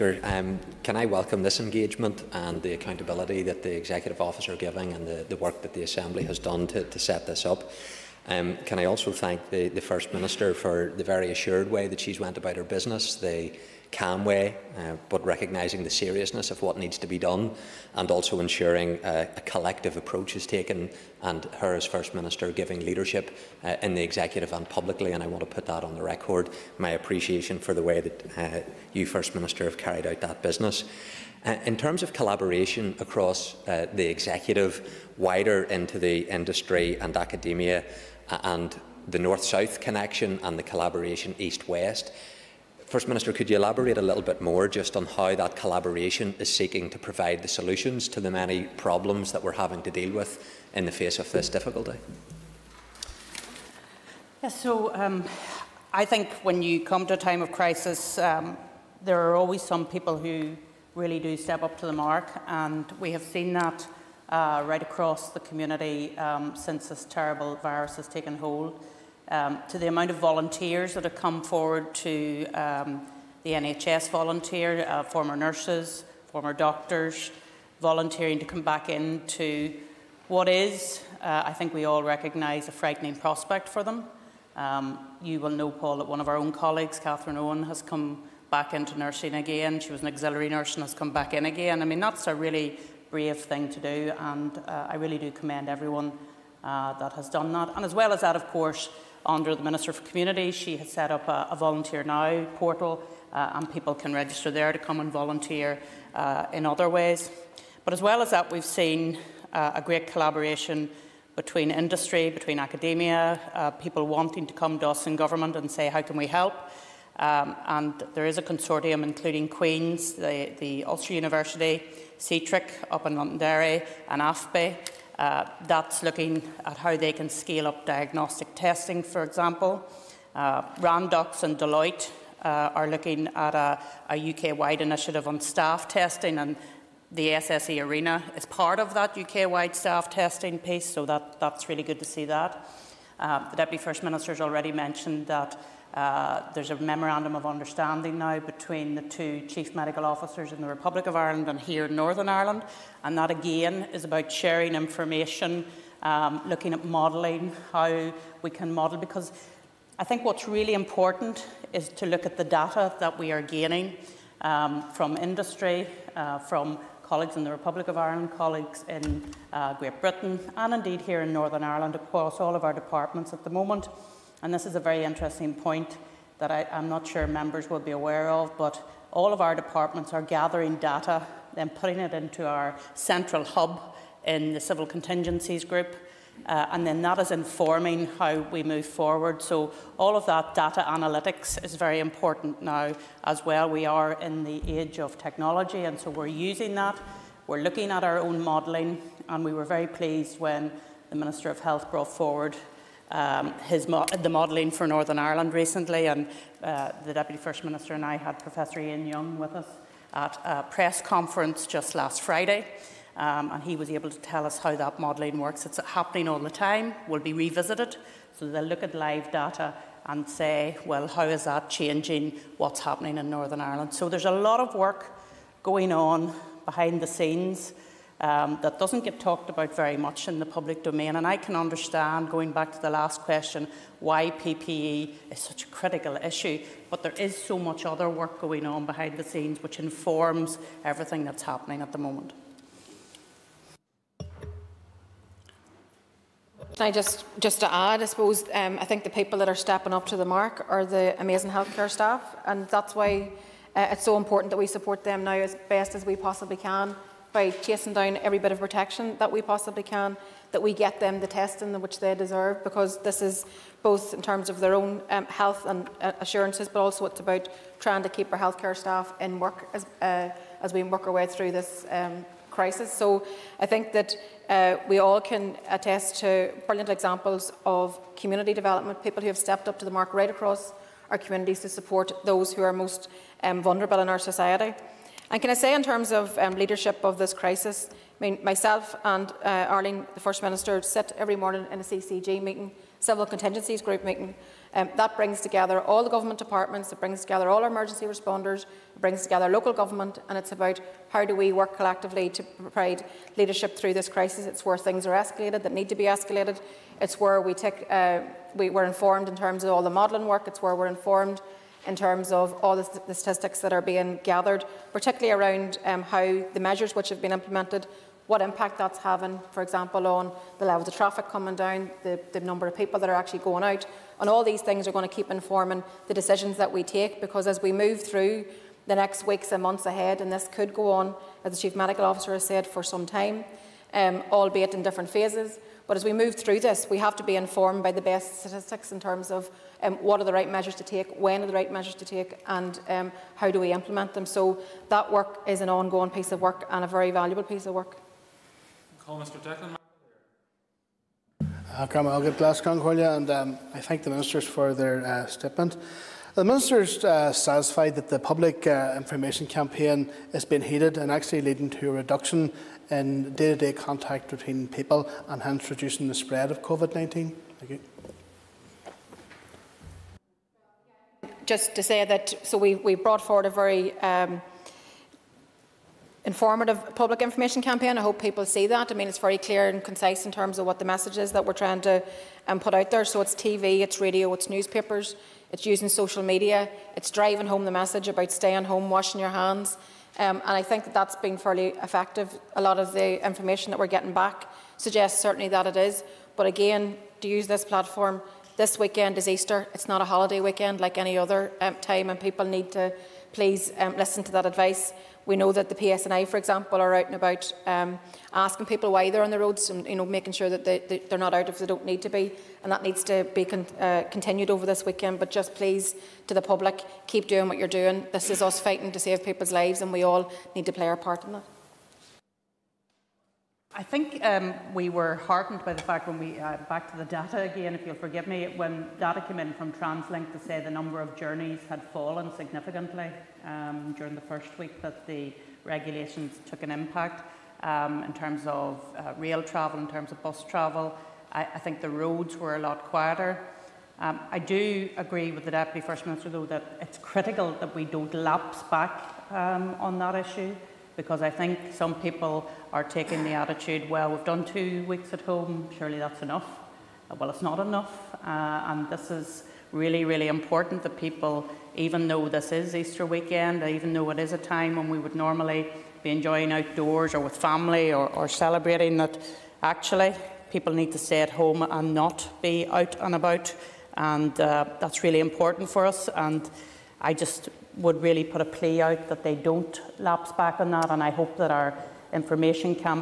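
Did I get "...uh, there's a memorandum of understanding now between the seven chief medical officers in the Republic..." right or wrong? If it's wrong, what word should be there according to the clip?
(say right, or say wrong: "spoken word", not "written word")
wrong: "two", not "seven".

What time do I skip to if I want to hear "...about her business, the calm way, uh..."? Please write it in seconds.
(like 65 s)
12 s.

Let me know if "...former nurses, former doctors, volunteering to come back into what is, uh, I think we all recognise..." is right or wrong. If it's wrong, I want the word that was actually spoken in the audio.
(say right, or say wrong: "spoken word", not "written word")
right.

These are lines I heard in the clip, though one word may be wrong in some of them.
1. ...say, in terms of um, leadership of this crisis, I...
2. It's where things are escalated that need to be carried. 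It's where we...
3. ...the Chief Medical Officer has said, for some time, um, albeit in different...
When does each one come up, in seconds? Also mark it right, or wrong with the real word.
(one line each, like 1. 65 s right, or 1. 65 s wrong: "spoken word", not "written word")
1. 285 s right
2. 304 s wrong: "escalated", not "carried"
3. 331 s right.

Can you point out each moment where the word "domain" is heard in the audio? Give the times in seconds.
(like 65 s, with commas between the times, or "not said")
230 s.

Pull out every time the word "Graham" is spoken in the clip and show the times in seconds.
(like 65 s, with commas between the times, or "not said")
351 s.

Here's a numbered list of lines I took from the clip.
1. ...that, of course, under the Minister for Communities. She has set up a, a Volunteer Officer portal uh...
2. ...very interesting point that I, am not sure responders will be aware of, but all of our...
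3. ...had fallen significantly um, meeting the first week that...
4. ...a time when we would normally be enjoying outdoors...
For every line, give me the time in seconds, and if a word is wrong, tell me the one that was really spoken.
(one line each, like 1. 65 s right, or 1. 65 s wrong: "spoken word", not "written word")
1. 98 s wrong: "Now", not "Officer"
2. 174 s wrong: "members", not "responders"
3. 431 s wrong: "during", not "meeting"
4. 464 s right.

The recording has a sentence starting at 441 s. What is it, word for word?
I, I think the roads were a lot quieter.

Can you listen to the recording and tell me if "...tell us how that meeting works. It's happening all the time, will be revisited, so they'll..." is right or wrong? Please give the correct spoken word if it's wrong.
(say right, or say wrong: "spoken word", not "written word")
wrong: "modelling", not "meeting".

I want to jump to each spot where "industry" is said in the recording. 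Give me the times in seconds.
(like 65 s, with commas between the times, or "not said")
36 s, 111 s, 165 s.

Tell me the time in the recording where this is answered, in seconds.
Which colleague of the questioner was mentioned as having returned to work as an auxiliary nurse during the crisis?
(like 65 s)
86 s.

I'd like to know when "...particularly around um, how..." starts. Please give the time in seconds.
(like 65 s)
314 s.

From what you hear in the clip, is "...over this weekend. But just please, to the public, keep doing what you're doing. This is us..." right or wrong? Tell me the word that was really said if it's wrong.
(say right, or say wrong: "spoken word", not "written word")
right.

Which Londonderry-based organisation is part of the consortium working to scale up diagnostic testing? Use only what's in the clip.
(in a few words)
C-TRIC.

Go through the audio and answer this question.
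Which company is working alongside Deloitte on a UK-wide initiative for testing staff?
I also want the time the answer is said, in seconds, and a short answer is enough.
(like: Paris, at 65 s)
Randox, at 130 s.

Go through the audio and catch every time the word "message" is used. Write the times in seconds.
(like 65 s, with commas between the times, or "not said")
380 s, 387 s.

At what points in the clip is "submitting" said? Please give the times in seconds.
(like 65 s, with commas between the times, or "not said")
not said.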